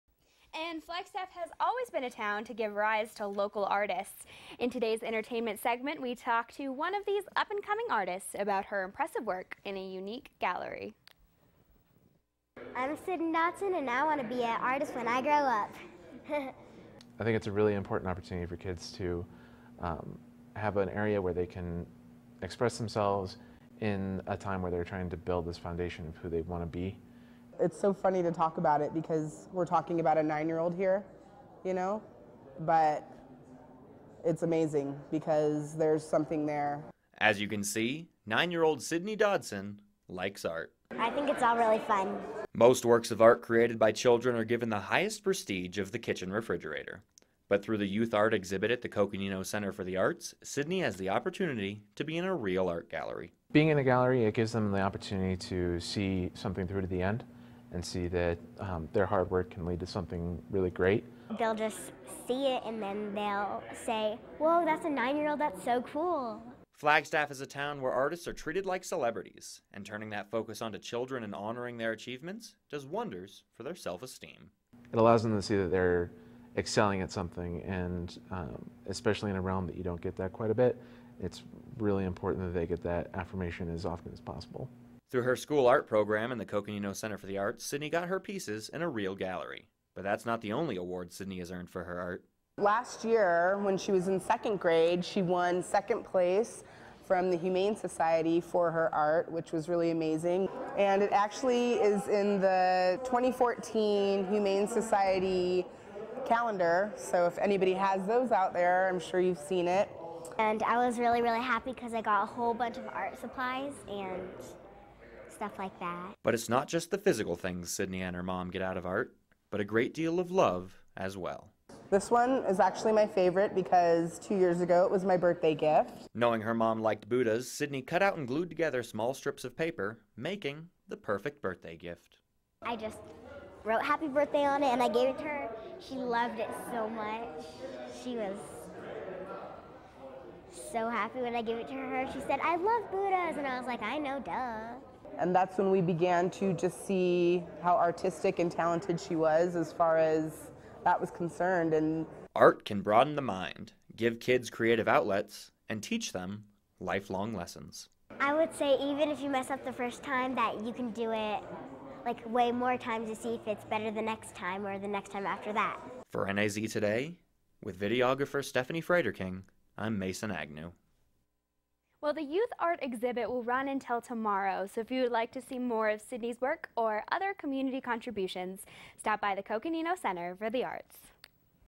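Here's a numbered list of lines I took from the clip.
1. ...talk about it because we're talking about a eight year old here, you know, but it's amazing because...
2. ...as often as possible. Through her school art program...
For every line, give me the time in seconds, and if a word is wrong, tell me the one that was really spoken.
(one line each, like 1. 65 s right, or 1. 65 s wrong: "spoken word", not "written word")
1. 28 s wrong: "nine", not "eight"
2. 83 s right.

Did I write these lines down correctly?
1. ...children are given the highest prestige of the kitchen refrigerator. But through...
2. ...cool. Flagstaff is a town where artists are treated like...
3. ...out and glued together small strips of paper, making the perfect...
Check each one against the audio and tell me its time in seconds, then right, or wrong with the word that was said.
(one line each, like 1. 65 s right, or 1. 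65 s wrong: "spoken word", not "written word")
1. 43 s right
2. 65 s right
3. 128 s right.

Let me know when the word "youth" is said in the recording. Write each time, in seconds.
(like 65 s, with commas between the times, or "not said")
47 s, 172 s.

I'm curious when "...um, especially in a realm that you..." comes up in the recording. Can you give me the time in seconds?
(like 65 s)
78 s.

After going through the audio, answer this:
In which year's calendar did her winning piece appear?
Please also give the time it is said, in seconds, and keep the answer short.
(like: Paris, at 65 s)
2014, at 103 s.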